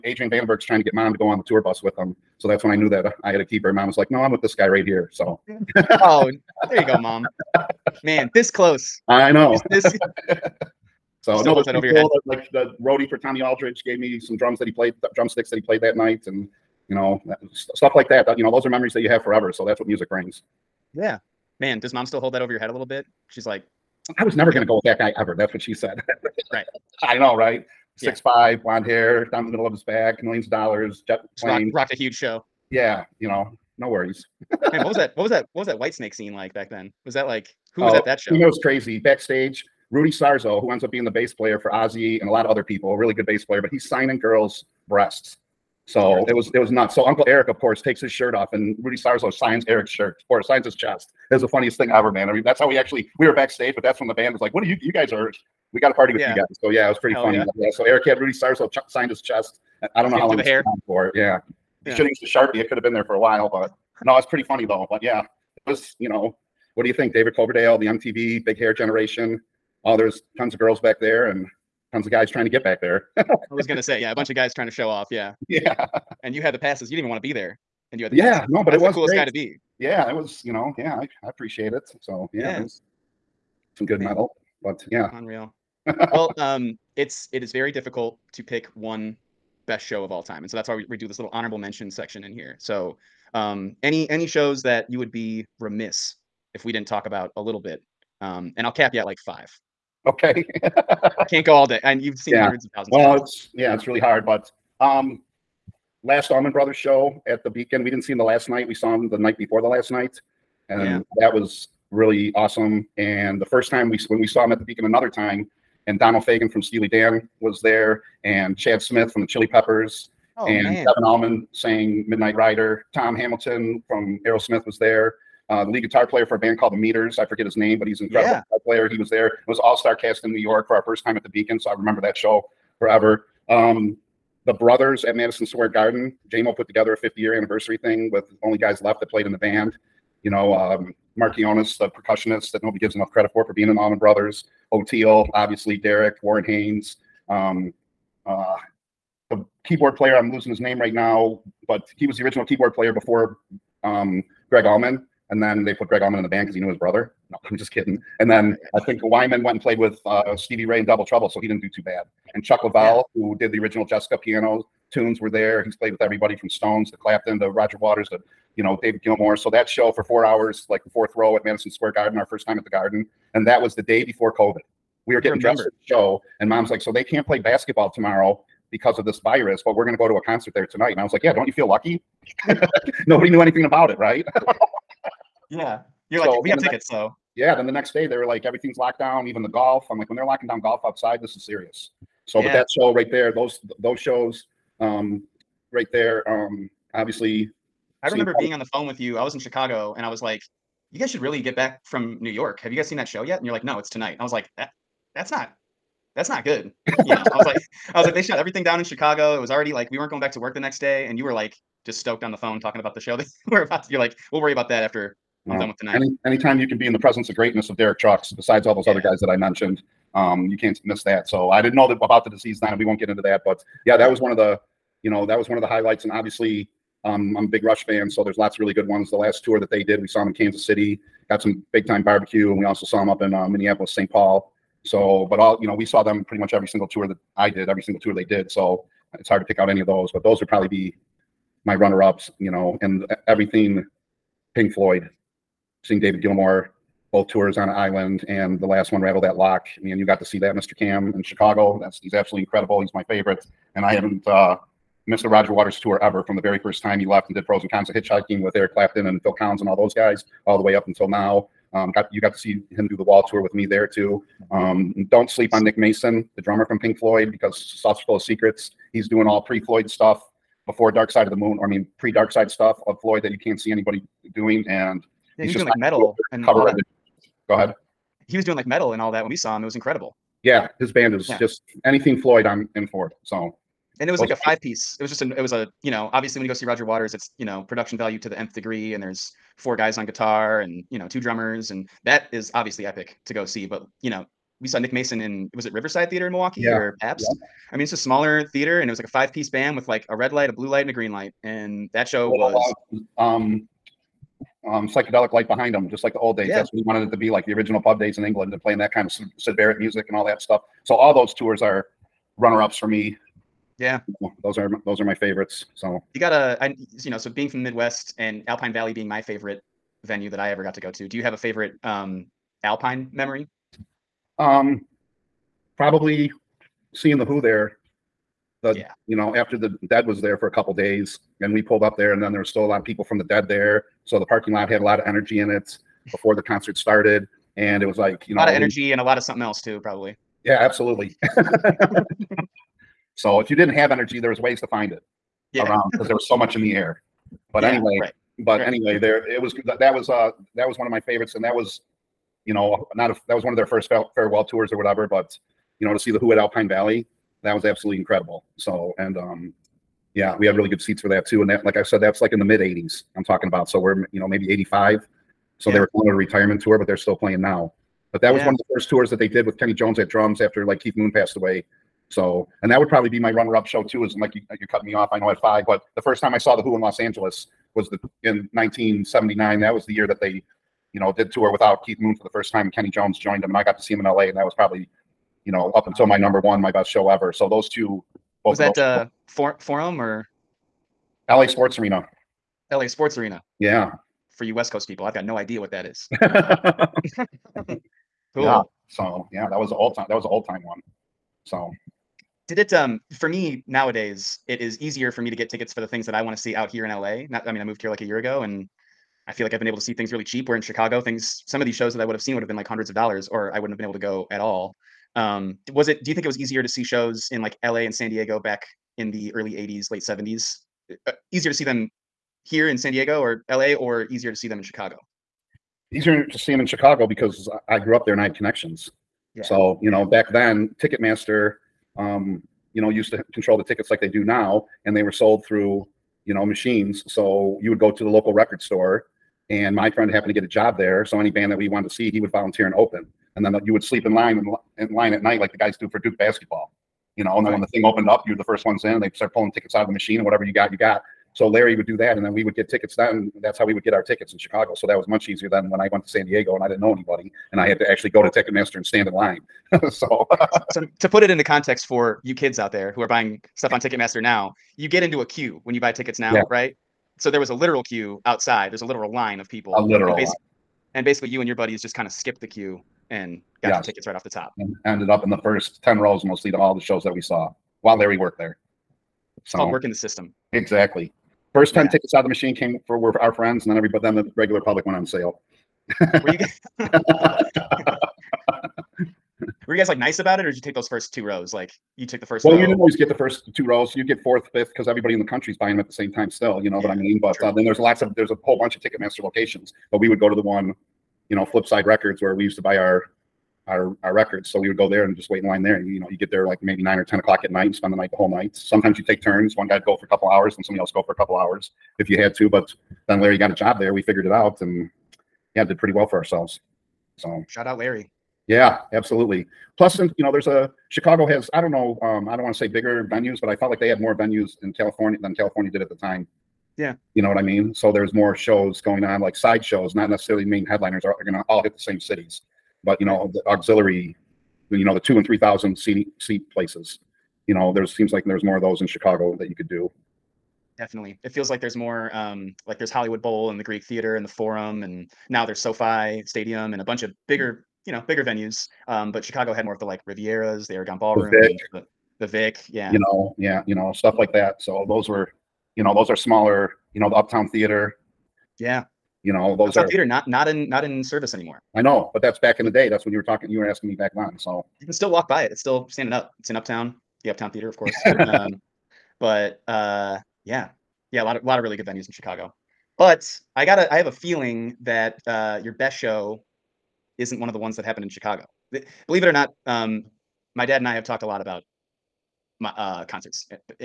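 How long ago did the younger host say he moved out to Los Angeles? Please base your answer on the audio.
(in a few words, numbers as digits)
a year ago.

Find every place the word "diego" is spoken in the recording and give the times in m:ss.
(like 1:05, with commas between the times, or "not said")
6:58, 7:02, 7:36.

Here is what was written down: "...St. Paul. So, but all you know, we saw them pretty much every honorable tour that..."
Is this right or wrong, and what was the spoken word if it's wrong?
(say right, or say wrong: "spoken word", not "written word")
wrong: "single", not "honorable".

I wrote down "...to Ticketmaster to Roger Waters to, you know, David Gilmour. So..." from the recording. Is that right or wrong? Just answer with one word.
wrong.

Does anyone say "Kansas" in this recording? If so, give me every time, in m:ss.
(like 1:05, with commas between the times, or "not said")
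3:50.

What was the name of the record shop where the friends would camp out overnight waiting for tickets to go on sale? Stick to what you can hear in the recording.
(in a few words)
Flipside Records.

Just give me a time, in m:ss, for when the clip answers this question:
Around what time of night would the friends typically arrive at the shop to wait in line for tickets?
8:26.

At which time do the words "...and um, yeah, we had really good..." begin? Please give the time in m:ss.
5:58.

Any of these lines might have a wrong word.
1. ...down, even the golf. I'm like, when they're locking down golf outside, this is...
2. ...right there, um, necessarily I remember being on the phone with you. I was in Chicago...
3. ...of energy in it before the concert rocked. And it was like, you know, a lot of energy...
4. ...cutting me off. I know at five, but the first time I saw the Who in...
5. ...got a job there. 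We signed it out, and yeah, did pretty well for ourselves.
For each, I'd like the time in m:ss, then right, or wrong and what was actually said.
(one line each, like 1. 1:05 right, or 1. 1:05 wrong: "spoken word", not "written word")
1. 3:08 right
2. 3:15 wrong: "obviously", not "necessarily"
3. 5:34 wrong: "started", not "rocked"
4. 6:14 right
5. 8:33 wrong: "figured", not "signed".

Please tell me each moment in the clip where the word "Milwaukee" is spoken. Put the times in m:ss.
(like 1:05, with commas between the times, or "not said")
4:56.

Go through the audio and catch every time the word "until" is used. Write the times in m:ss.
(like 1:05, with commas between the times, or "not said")
4:20, 6:25.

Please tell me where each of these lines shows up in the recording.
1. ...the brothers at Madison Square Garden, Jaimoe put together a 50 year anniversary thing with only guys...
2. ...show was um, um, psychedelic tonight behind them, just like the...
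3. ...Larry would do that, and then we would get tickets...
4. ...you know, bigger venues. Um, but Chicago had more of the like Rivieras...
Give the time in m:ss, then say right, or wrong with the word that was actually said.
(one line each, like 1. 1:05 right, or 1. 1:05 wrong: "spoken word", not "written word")
1. 2:14 right
2. 5:02 wrong: "light", not "tonight"
3. 7:31 right
4. 9:07 right.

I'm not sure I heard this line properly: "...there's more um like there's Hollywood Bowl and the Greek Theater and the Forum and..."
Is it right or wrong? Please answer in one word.
right.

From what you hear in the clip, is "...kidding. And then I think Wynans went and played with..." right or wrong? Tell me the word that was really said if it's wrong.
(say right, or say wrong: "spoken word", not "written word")
right.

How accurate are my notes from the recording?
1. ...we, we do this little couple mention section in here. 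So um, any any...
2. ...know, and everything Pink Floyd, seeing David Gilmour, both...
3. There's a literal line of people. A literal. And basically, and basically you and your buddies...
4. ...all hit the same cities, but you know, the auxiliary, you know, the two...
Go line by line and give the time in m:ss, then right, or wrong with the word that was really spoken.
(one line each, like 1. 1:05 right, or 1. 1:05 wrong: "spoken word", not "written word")
1. 1:30 wrong: "honorable", not "couple"
2. 4:02 right
3. 7:48 right
4. 8:51 right.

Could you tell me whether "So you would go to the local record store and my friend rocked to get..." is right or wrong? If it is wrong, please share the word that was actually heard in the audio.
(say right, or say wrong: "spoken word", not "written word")
wrong: "happened", not "rocked".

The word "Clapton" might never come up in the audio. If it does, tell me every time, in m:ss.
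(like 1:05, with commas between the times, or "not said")
2:46, 4:18.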